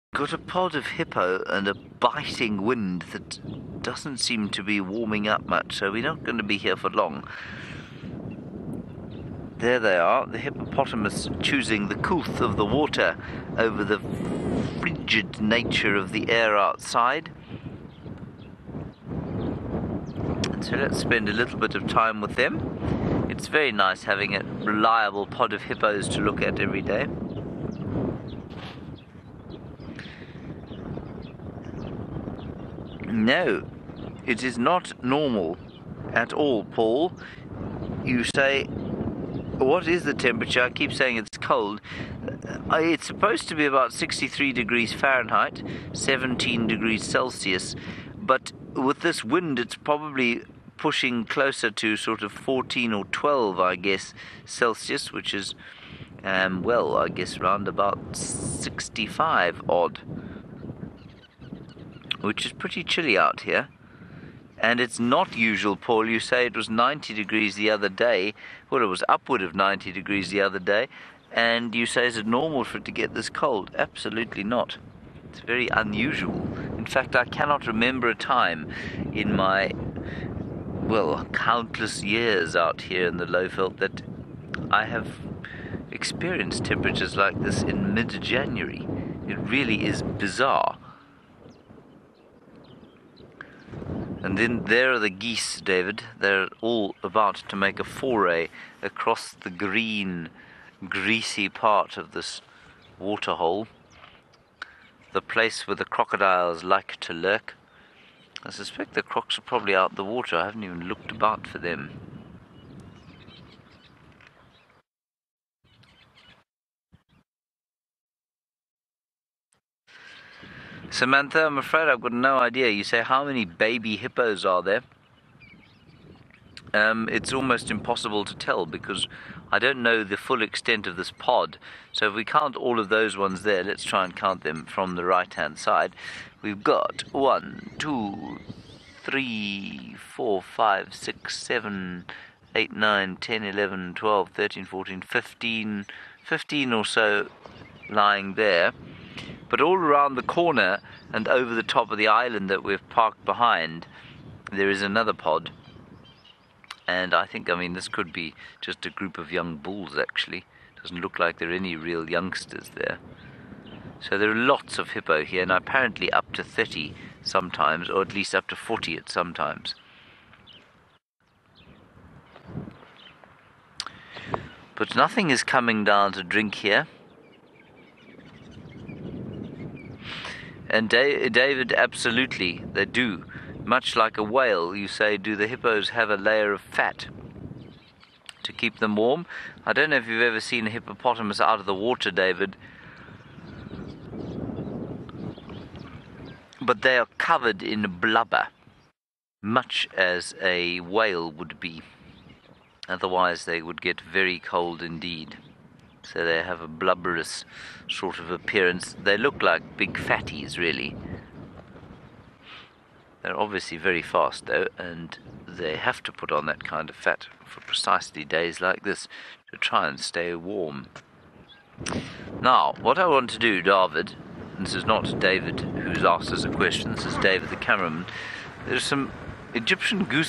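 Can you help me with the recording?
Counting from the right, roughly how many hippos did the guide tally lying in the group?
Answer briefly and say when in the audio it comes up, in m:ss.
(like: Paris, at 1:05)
15, at 2:26.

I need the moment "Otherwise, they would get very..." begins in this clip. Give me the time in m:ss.
3:22.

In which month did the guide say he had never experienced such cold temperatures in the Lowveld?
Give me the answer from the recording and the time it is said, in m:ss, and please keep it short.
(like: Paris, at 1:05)
January, at 1:28.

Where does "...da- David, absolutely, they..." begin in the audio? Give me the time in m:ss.
3:00.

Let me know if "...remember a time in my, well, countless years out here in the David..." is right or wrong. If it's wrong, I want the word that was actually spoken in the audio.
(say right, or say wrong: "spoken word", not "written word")
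wrong: "Lowveld", not "David".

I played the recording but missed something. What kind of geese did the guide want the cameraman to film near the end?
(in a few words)
Egyptian goose.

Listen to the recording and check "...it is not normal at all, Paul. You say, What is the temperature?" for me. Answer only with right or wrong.
right.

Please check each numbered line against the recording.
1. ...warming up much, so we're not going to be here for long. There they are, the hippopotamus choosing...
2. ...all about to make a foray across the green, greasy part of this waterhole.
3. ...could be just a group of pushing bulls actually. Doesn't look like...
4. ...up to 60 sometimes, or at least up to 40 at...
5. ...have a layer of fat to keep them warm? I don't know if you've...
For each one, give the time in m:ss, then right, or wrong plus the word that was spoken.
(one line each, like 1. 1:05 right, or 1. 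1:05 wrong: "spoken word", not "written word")
1. 0:04 right
2. 1:36 right
3. 2:37 wrong: "young", not "pushing"
4. 2:46 wrong: "30", not "60"
5. 3:05 right.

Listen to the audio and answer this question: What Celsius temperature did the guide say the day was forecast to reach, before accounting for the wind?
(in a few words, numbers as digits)
17 degrees Celsius.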